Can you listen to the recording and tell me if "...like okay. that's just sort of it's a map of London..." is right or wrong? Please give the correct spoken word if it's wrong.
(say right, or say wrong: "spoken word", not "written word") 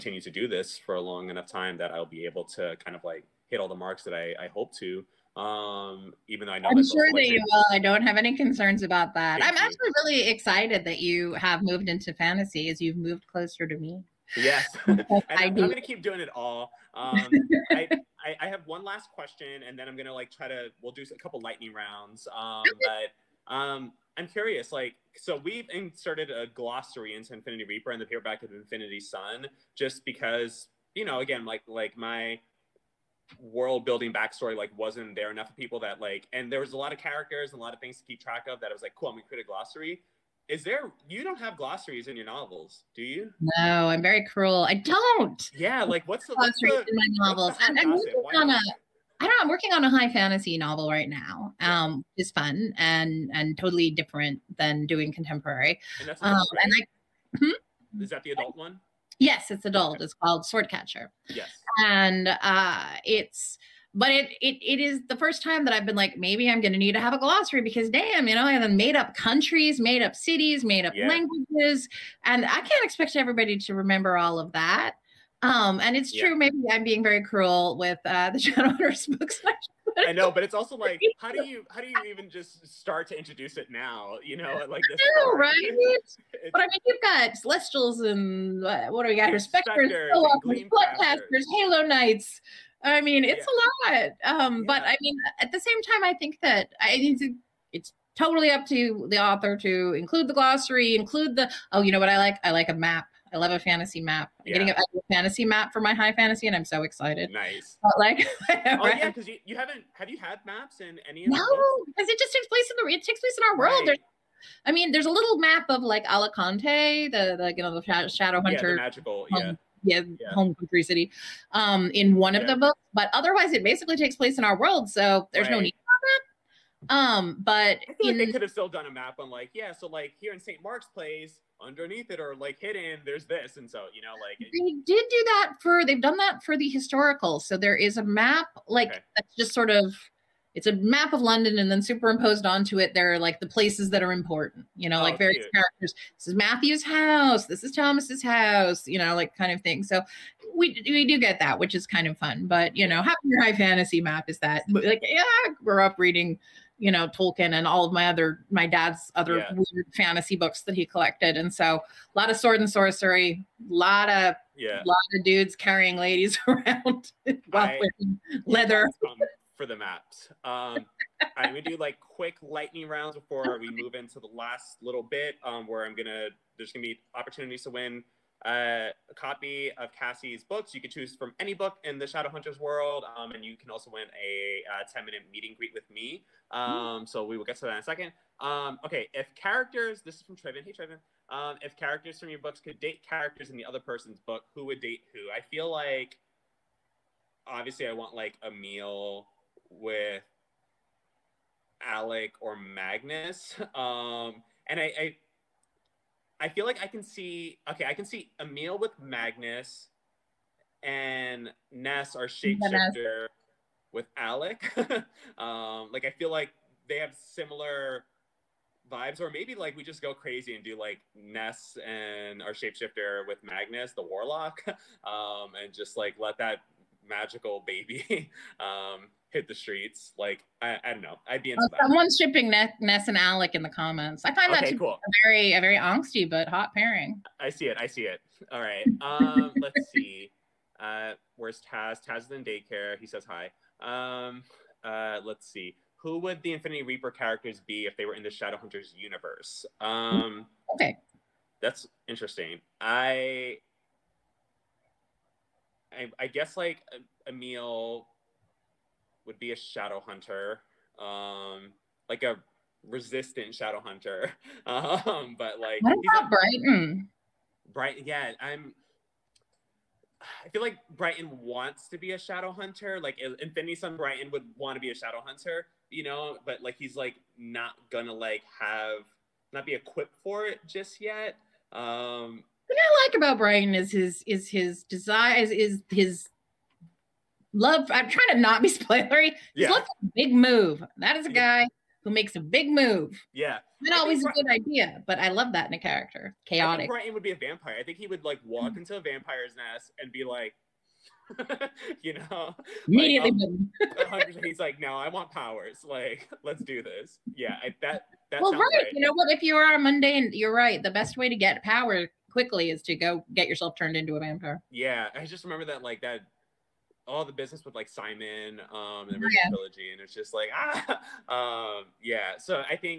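right.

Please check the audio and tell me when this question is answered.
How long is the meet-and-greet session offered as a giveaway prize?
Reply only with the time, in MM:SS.
03:04.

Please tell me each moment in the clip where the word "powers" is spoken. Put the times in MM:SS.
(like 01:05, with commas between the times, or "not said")
05:05, 05:11.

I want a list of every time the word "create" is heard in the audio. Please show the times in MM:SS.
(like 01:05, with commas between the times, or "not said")
00:39.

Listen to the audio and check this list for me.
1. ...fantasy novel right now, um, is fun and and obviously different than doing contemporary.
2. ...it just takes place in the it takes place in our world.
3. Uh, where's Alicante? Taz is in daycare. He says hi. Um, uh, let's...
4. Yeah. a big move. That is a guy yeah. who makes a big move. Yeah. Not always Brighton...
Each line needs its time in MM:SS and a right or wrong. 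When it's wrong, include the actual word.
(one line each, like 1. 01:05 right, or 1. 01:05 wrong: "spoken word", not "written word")
1. 00:50 wrong: "totally", not "obviously"
2. 01:52 right
3. 04:00 wrong: "Taz", not "Alicante"
4. 04:49 right.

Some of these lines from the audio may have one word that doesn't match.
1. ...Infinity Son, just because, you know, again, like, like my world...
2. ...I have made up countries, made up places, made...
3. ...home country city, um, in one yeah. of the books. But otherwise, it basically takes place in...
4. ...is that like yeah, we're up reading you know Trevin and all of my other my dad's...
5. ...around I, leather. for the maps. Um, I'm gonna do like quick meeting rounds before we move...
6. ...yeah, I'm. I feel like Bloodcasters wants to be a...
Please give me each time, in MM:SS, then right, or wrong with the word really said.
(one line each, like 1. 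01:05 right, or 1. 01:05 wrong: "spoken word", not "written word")
1. 00:28 right
2. 01:08 wrong: "cities", not "places"
3. 02:00 right
4. 02:34 wrong: "Tolkien", not "Trevin"
5. 02:46 wrong: "lightning", not "meeting"
6. 04:28 wrong: "Brighton", not "Bloodcasters".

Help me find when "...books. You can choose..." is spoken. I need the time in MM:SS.
03:00.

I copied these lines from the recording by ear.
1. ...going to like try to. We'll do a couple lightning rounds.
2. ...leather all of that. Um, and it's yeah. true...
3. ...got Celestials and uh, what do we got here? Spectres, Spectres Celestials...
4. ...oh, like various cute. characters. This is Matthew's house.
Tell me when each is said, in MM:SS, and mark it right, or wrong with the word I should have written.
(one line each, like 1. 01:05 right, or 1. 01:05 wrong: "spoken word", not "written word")
1. 00:19 right
2. 01:13 wrong: "remember", not "leather"
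3. 01:27 wrong: "Bloodcasters", not "Celestials"
4. 02:24 right.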